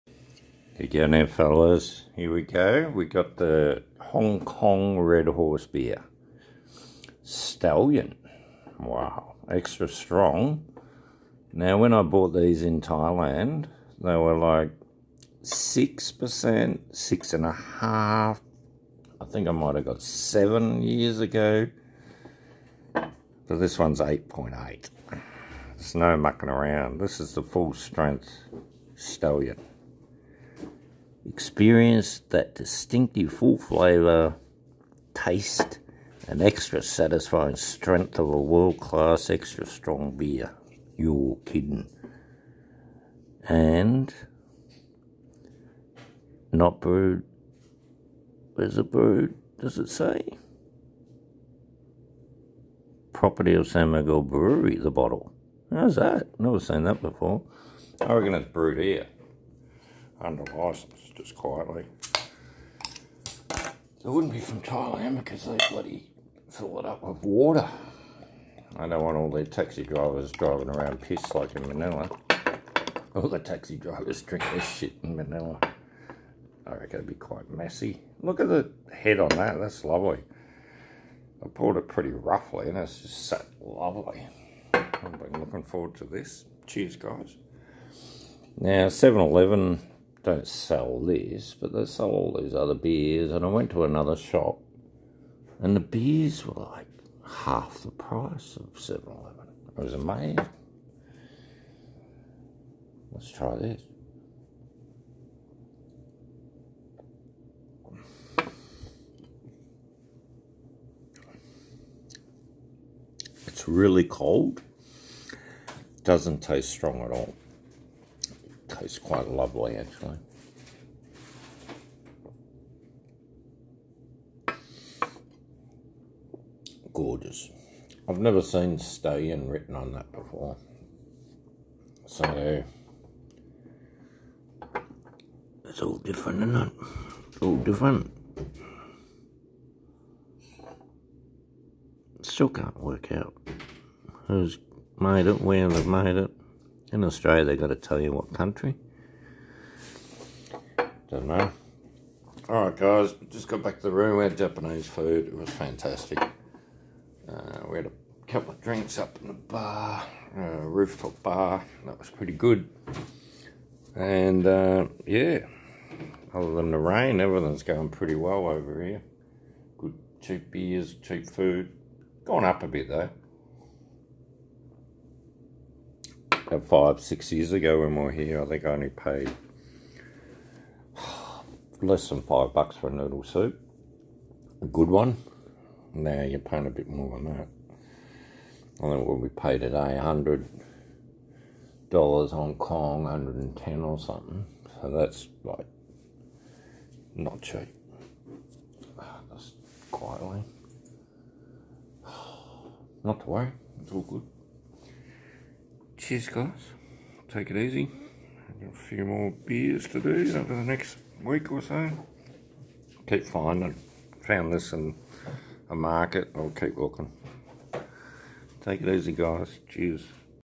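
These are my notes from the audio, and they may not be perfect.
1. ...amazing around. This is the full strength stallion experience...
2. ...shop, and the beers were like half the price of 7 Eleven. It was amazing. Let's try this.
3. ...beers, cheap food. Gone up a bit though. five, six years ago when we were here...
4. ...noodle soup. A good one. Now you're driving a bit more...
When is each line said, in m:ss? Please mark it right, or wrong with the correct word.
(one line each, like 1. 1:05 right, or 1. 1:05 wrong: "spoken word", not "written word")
1. 0:26 wrong: "mucking", not "amazing"
2. 1:34 right
3. 2:50 right
4. 3:02 wrong: "paying", not "driving".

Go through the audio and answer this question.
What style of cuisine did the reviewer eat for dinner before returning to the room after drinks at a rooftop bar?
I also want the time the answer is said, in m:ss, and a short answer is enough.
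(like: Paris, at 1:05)
Japanese, at 2:34.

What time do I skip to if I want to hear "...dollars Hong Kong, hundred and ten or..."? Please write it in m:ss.
3:11.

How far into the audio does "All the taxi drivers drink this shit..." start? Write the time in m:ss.
1:13.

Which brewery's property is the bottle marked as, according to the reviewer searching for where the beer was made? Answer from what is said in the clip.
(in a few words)
San Miguel Brewery.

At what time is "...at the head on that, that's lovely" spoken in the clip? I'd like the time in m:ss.
1:18.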